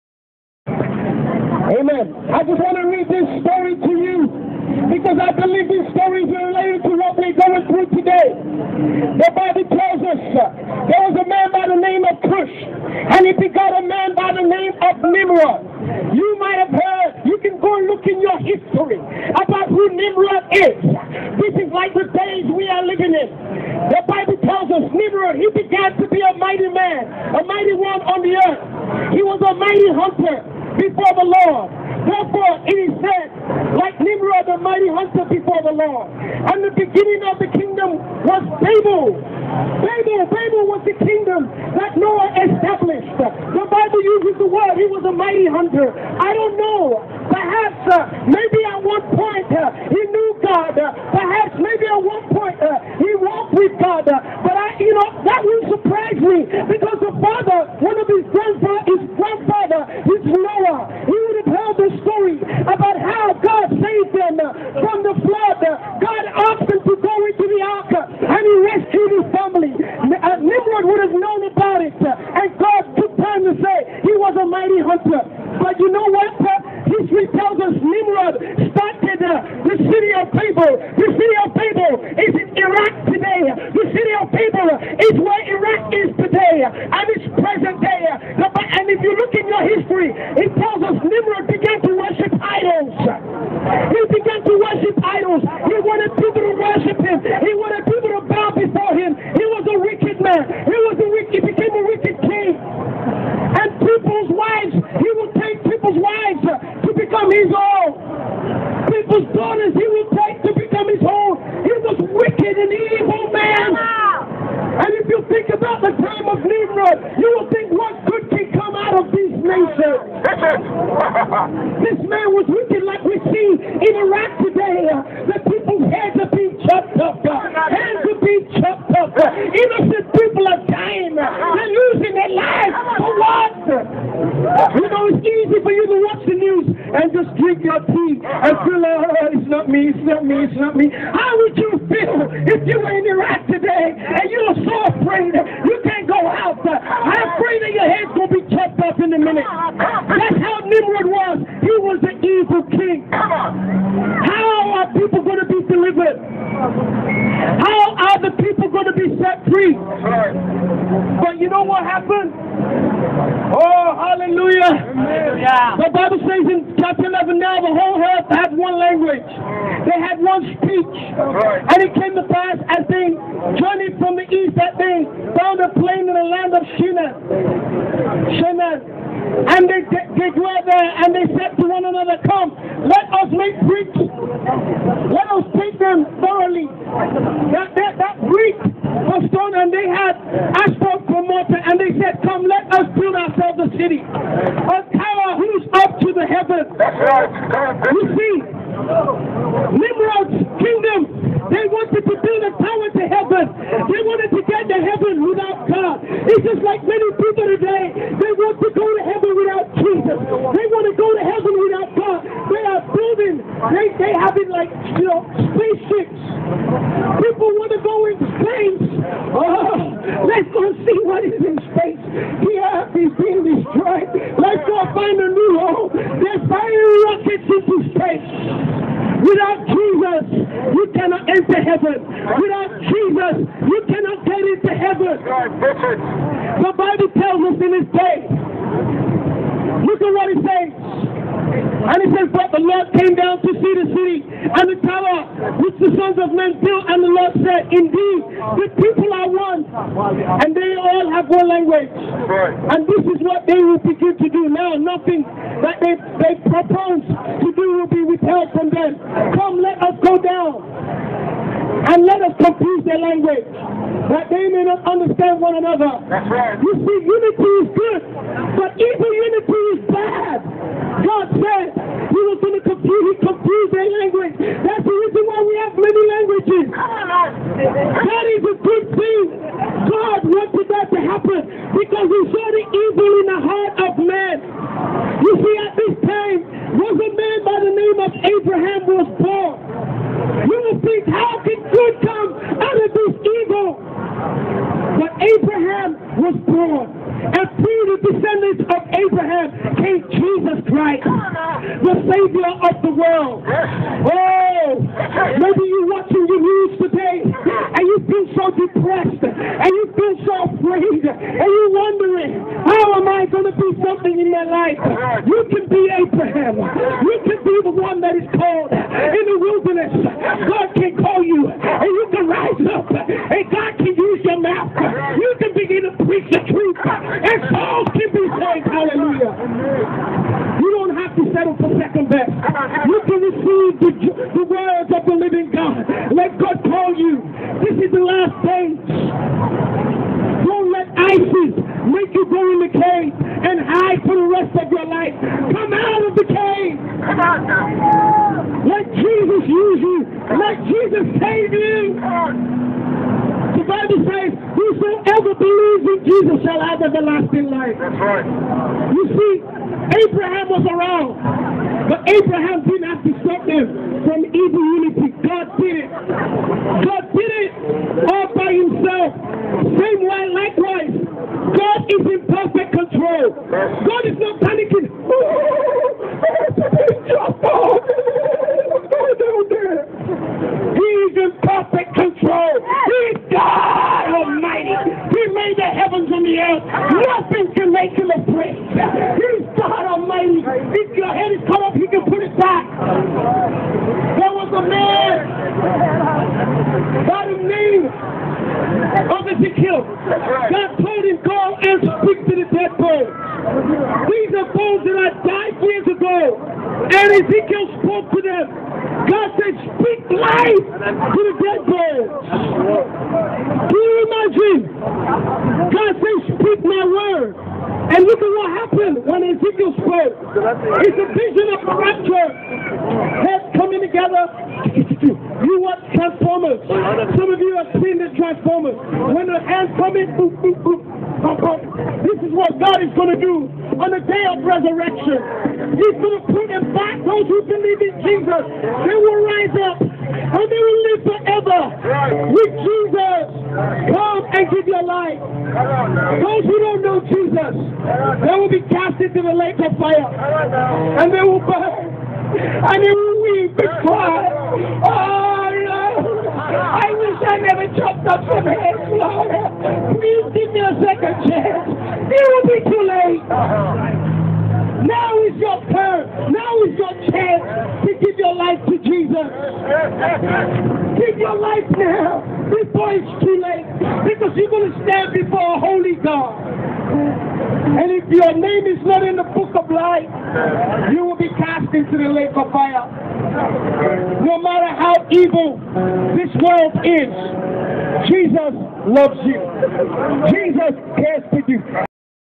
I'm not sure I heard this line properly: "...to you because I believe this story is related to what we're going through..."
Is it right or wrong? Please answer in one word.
right.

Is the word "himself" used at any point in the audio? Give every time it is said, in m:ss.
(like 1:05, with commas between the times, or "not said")
6:08.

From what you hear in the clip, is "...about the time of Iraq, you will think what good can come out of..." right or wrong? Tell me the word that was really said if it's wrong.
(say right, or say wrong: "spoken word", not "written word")
wrong: "Nimrod", not "Iraq".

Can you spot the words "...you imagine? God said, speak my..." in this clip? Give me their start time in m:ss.
6:53.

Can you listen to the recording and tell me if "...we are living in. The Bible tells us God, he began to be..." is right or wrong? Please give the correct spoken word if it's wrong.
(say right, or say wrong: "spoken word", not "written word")
wrong: "Nimrod", not "God".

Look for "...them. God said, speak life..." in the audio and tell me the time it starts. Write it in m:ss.
6:48.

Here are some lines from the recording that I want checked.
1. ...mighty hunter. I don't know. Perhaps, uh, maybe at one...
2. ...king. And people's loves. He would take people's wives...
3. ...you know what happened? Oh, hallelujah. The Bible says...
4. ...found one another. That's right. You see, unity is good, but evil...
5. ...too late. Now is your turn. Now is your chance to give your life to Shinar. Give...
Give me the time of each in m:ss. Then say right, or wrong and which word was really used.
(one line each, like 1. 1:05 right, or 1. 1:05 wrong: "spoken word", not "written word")
1. 0:45 right
2. 1:42 wrong: "wives", not "loves"
3. 2:41 right
4. 4:24 wrong: "understand", not "found"
5. 7:42 wrong: "Jesus", not "Shinar".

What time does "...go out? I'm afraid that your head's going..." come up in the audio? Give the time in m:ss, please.
2:26.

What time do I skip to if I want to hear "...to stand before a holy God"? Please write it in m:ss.
7:54.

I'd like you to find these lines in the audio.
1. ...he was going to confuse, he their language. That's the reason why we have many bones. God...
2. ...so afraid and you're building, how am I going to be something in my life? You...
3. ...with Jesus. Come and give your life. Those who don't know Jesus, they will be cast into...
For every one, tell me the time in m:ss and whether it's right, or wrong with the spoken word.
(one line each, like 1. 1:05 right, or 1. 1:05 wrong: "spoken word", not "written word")
1. 4:32 wrong: "languages", not "bones"
2. 5:10 wrong: "wondering", not "building"
3. 7:22 right.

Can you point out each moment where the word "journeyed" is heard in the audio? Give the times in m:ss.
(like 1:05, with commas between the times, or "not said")
2:53.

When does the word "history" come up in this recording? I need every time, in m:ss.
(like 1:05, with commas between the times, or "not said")
0:18, 1:29.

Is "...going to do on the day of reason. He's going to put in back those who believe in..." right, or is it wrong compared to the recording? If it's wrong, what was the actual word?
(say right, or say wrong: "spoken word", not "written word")
wrong: "resurrection", not "reason".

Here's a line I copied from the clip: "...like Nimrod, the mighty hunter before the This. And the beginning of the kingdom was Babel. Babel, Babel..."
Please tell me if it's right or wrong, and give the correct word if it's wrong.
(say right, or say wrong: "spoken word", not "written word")
wrong: "Lord", not "This".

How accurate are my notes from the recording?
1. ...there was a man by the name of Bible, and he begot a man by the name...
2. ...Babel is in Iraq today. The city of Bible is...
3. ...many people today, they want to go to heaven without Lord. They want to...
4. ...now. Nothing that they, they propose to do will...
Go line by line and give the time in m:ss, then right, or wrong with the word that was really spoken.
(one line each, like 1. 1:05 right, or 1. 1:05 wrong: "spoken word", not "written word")
1. 0:10 wrong: "Cush", not "Bible"
2. 1:21 wrong: "Babel", not "Bible"
3. 3:26 wrong: "Jesus", not "Lord"
4. 4:14 right.